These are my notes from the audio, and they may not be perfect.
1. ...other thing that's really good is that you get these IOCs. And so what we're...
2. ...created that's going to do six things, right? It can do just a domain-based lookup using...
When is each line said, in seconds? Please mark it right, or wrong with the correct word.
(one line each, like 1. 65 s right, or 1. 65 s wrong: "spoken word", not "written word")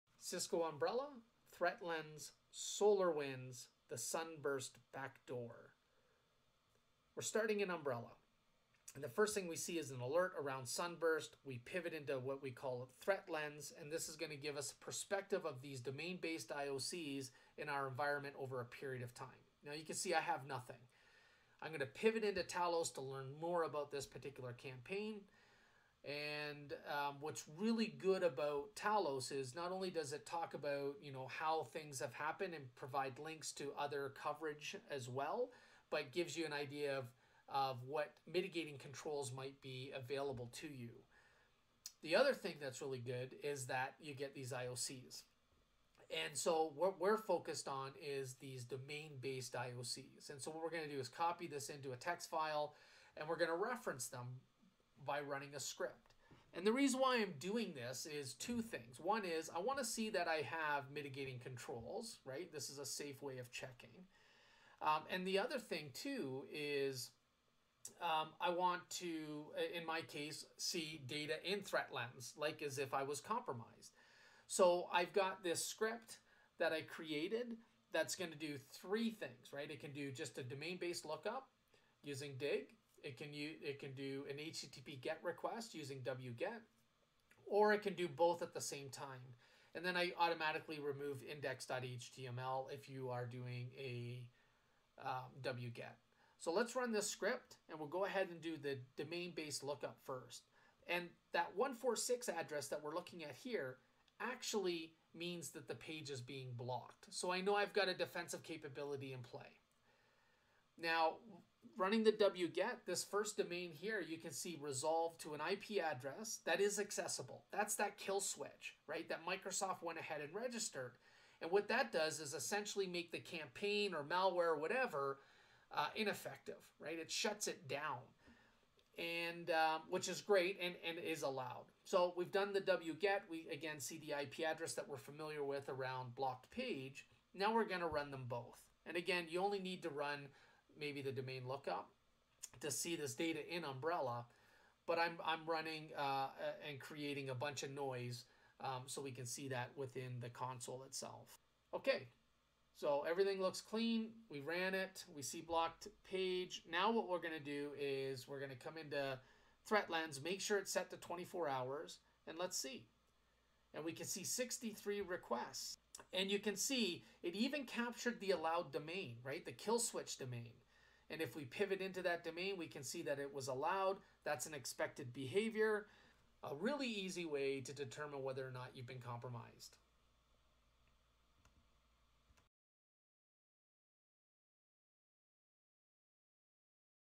1. 42 s right
2. 76 s wrong: "three", not "six".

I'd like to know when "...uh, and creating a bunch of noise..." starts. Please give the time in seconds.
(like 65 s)
146 s.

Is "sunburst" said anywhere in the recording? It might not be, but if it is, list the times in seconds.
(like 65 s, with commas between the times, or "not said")
3 s, 10 s.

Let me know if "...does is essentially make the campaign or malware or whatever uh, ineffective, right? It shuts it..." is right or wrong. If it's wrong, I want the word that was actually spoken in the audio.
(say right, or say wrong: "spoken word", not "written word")
right.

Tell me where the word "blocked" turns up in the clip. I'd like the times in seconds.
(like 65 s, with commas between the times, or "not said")
106 s, 136 s, 155 s.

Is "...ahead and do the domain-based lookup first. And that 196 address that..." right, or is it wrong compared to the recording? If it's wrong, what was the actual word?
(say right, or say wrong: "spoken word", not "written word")
wrong: "146", not "196".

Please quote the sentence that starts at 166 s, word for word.
And you can see it even captured the allowed domain, right?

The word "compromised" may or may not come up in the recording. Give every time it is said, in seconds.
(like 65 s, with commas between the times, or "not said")
73 s, 179 s.